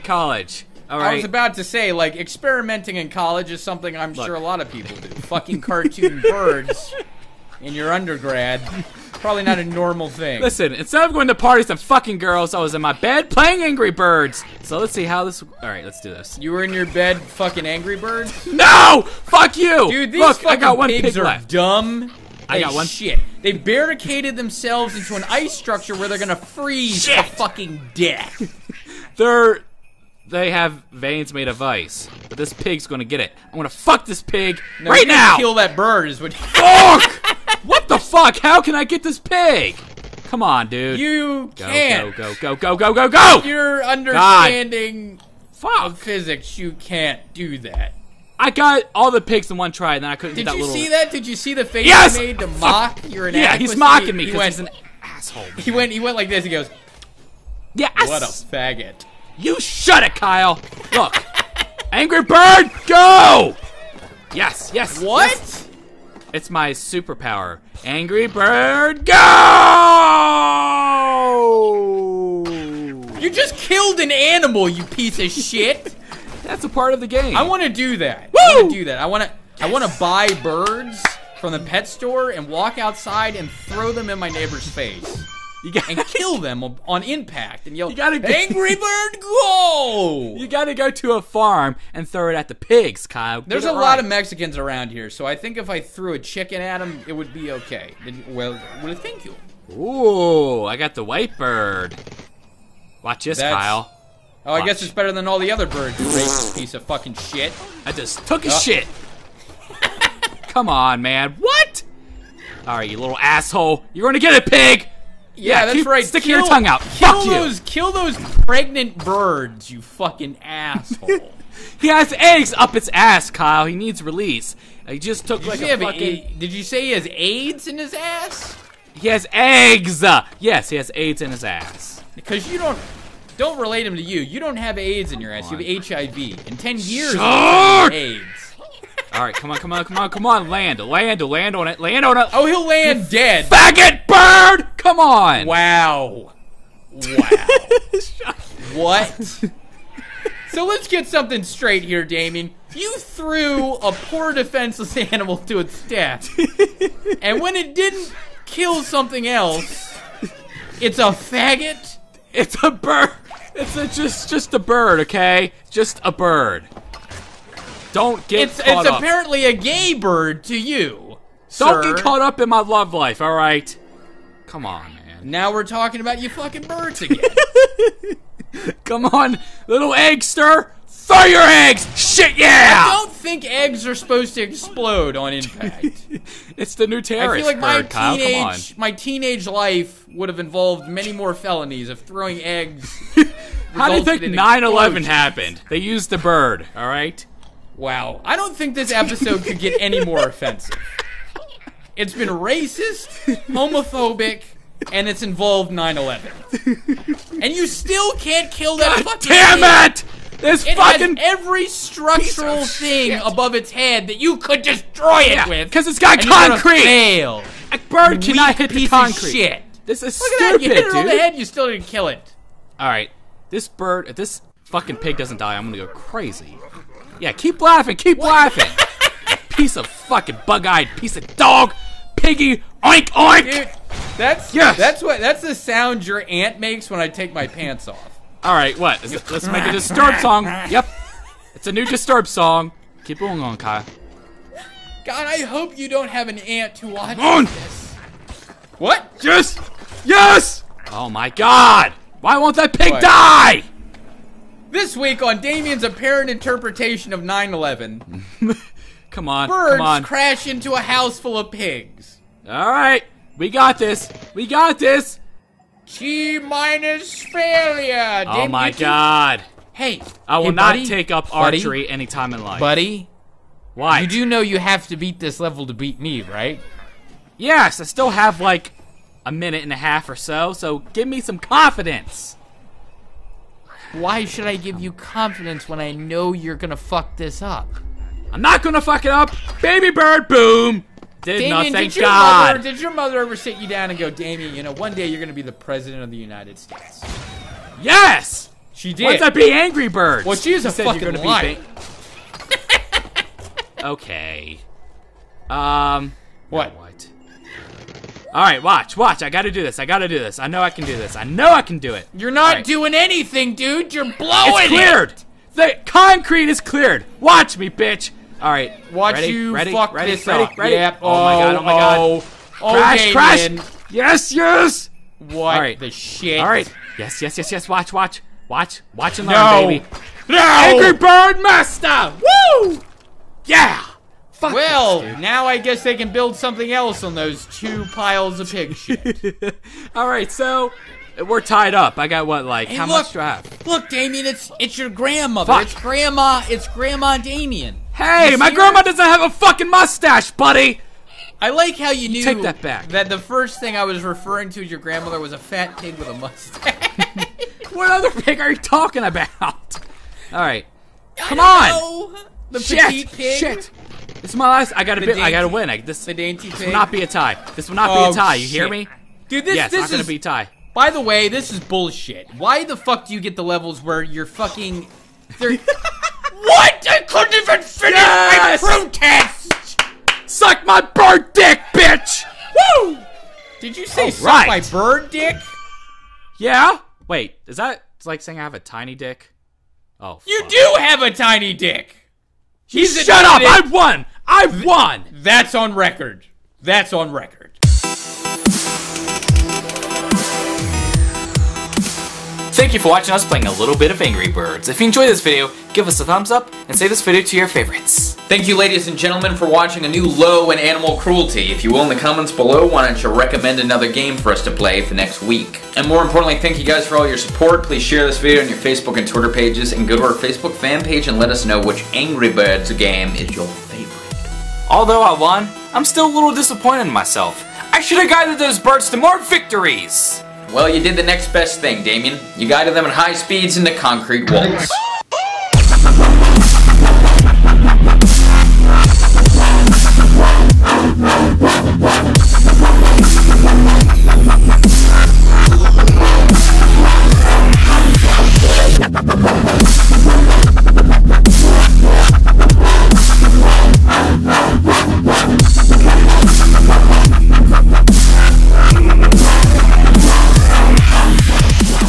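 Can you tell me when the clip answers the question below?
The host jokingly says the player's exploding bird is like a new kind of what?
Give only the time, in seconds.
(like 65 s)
187 s.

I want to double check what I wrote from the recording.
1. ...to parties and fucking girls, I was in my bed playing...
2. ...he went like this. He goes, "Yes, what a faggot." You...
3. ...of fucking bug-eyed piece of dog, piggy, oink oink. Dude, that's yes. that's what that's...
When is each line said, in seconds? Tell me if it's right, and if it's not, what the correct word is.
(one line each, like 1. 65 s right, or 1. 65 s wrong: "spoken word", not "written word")
1. 11 s right
2. 55 s right
3. 229 s right.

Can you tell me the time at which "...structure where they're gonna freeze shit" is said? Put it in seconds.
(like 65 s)
25 s.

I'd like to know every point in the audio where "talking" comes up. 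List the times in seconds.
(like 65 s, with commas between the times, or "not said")
175 s, 358 s.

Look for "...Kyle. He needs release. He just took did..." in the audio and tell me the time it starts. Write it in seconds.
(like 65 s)
123 s.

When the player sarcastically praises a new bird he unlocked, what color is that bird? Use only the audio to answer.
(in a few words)
White.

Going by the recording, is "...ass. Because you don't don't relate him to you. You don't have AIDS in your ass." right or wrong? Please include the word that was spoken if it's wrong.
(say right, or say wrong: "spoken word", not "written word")
right.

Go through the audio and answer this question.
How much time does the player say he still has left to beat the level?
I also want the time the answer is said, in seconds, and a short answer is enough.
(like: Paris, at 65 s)
A minute and a half, at 279 s.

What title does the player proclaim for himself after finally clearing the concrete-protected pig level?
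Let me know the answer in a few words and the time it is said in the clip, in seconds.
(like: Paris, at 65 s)
Angry Bird Master, at 330 s.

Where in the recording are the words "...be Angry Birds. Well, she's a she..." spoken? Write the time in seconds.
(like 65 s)
299 s.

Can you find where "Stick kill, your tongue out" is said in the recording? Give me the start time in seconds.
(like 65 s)
116 s.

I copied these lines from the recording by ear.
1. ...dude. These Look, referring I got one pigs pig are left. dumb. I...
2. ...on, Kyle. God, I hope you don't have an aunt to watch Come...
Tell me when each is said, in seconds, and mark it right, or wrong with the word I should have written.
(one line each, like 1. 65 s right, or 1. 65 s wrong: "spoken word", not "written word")
1. 19 s wrong: "fucking", not "referring"
2. 243 s right.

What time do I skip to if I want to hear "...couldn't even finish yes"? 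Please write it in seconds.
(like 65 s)
377 s.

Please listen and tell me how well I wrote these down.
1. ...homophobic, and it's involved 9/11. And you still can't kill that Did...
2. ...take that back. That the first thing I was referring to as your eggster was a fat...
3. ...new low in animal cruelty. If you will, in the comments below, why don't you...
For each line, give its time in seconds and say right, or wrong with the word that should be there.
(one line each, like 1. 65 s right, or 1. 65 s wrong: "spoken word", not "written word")
1. 203 s wrong: "God", not "Did"
2. 352 s wrong: "grandmother", not "eggster"
3. 409 s right.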